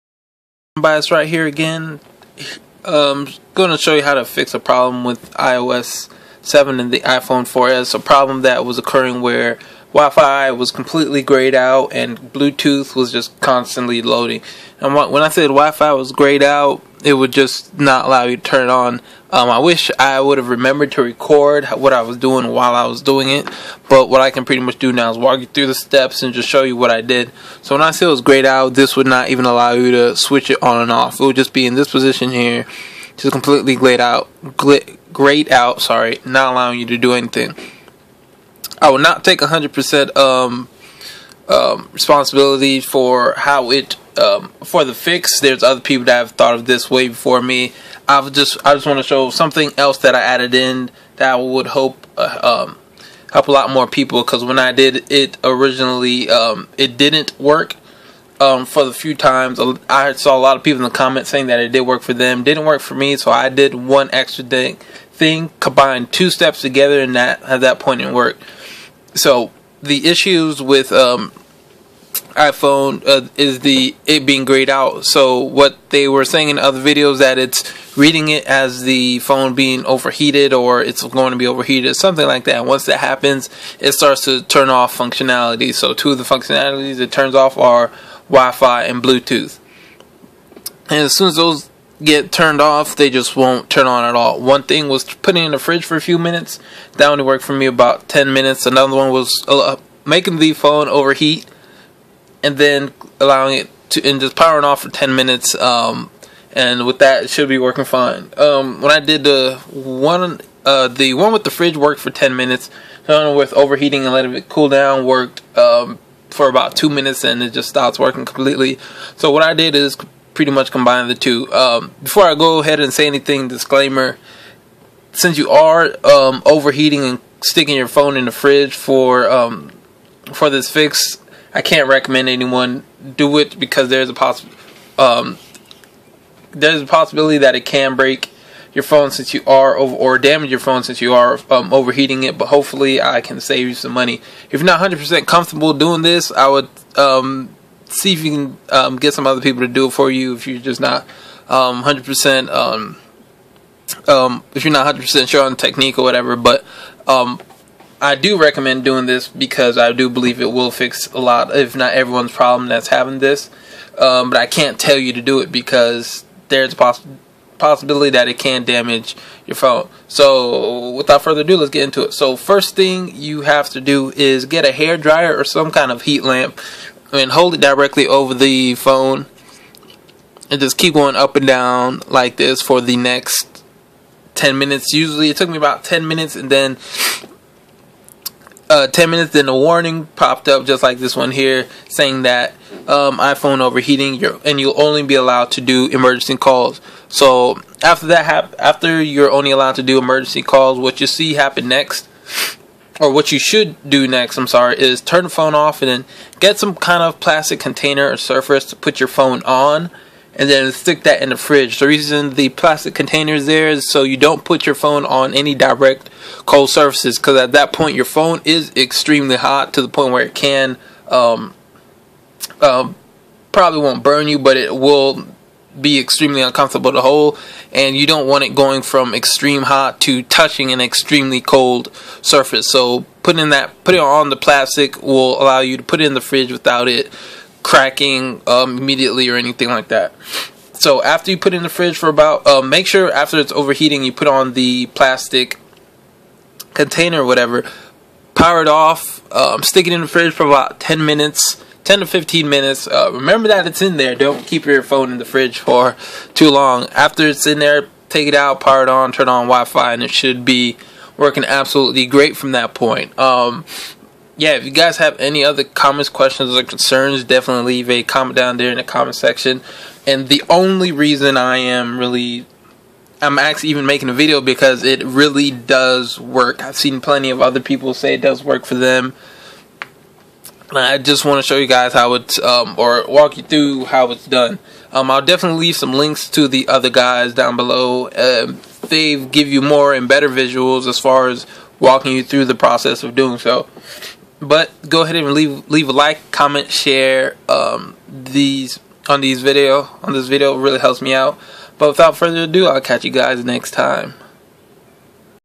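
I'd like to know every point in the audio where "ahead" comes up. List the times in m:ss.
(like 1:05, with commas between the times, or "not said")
2:02, 4:55.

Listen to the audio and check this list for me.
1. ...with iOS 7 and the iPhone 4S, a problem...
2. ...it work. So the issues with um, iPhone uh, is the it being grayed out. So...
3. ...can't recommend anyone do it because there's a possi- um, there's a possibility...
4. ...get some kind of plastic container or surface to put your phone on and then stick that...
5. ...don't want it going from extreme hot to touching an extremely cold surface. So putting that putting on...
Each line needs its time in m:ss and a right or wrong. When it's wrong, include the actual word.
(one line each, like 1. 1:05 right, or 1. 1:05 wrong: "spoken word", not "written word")
1. 0:05 right
2. 1:08 right
3. 2:11 right
4. 3:26 right
5. 3:48 right.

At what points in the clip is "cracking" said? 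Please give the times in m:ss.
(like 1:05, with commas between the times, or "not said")
3:57.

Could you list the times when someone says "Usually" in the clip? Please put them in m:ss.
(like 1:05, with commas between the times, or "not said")
3:04.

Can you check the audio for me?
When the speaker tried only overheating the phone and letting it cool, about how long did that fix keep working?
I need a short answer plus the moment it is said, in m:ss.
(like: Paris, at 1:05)
2 minutes, at 1:56.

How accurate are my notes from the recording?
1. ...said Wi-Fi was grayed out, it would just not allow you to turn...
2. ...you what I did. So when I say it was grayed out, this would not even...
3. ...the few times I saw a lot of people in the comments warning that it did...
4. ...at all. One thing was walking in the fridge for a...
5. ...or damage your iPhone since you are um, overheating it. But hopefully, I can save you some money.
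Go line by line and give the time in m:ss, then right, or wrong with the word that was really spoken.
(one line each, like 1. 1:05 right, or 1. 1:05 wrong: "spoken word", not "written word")
1. 0:15 right
2. 0:26 right
3. 0:58 wrong: "saying", not "warning"
4. 1:34 wrong: "putting", not "walking"
5. 2:19 wrong: "phone", not "iPhone".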